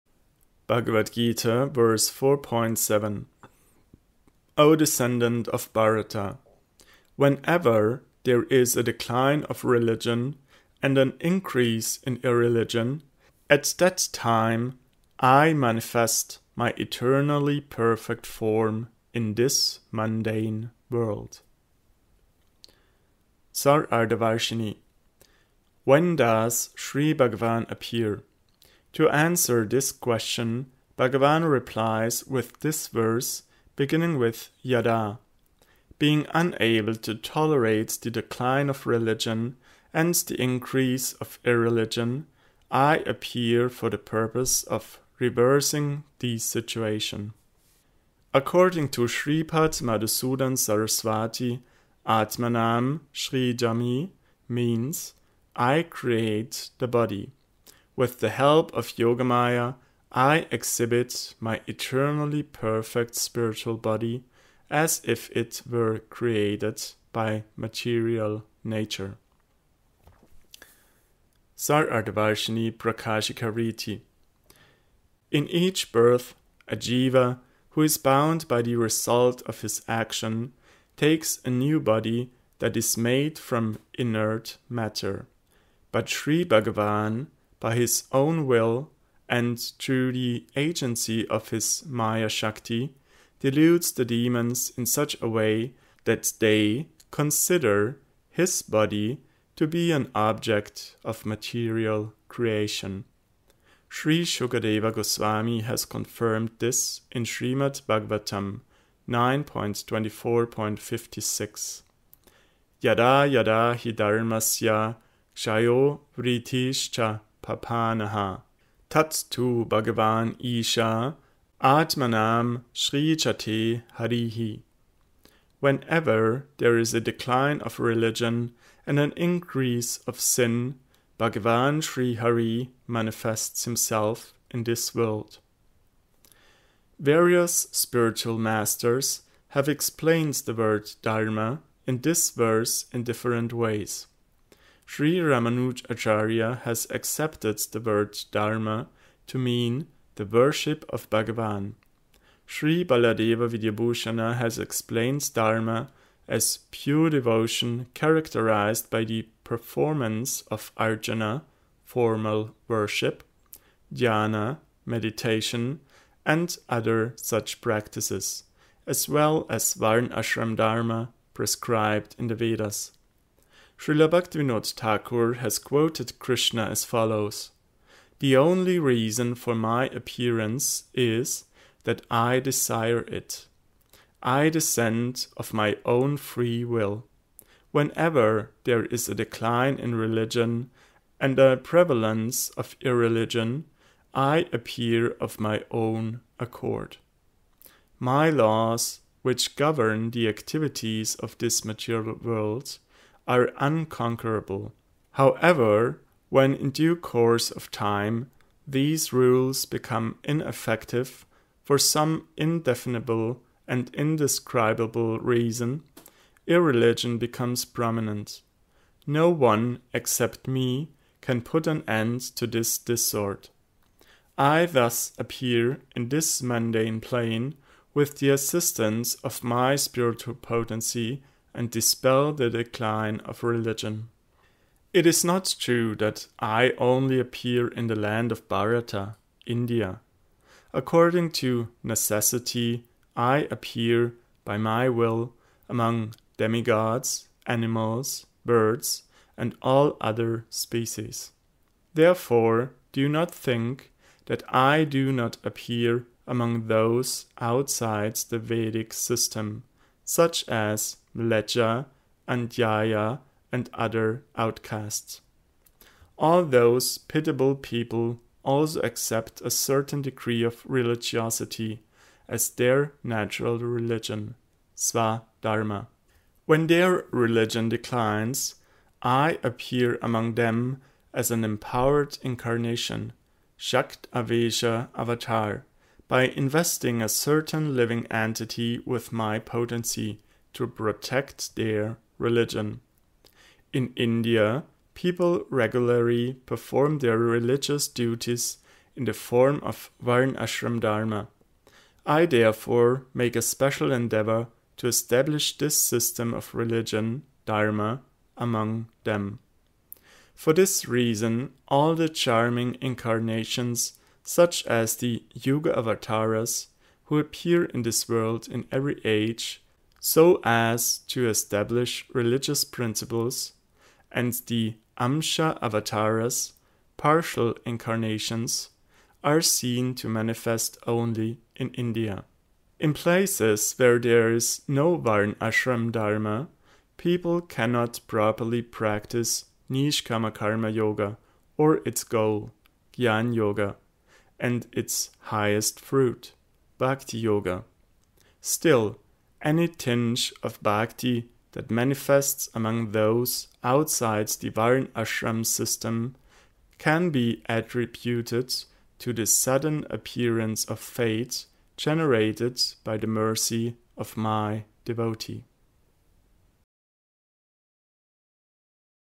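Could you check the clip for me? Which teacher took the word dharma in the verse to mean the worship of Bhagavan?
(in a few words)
Ramanuj Acharya.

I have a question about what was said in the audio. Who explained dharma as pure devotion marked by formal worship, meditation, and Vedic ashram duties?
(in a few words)
Baladeva Vidyabhushana.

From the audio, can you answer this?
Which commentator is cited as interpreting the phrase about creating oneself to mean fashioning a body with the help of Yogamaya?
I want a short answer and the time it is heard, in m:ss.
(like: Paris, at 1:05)
Madhusudan Saraswati, at 0:49.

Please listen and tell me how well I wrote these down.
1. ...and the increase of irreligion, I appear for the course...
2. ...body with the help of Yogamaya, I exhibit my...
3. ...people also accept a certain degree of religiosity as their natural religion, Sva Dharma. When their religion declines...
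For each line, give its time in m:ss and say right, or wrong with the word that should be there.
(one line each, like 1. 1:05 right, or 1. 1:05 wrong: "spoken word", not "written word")
1. 0:39 wrong: "purpose", not "course"
2. 0:56 right
3. 4:27 right.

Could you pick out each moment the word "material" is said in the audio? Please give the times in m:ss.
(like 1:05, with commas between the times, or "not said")
1:07, 1:41, 3:21.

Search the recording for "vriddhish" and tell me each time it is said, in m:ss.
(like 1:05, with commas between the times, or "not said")
1:56.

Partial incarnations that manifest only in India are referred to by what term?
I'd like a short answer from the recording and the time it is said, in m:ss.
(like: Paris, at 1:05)
Amsha avatars, at 5:24.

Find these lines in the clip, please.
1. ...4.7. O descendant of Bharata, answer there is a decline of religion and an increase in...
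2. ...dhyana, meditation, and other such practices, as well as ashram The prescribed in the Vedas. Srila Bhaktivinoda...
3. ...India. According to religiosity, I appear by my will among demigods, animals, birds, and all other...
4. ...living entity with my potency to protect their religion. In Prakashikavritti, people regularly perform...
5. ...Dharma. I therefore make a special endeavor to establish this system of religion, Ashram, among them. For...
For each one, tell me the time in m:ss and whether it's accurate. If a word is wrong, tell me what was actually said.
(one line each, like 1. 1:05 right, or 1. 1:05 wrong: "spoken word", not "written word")
1. 0:02 wrong: "whenever", not "answer"
2. 2:43 wrong: "Dharma", not "The"
3. 3:59 wrong: "necessity", not "religiosity"
4. 4:47 wrong: "India", not "Prakashikavritti"
5. 5:00 wrong: "Dharma", not "Ashram".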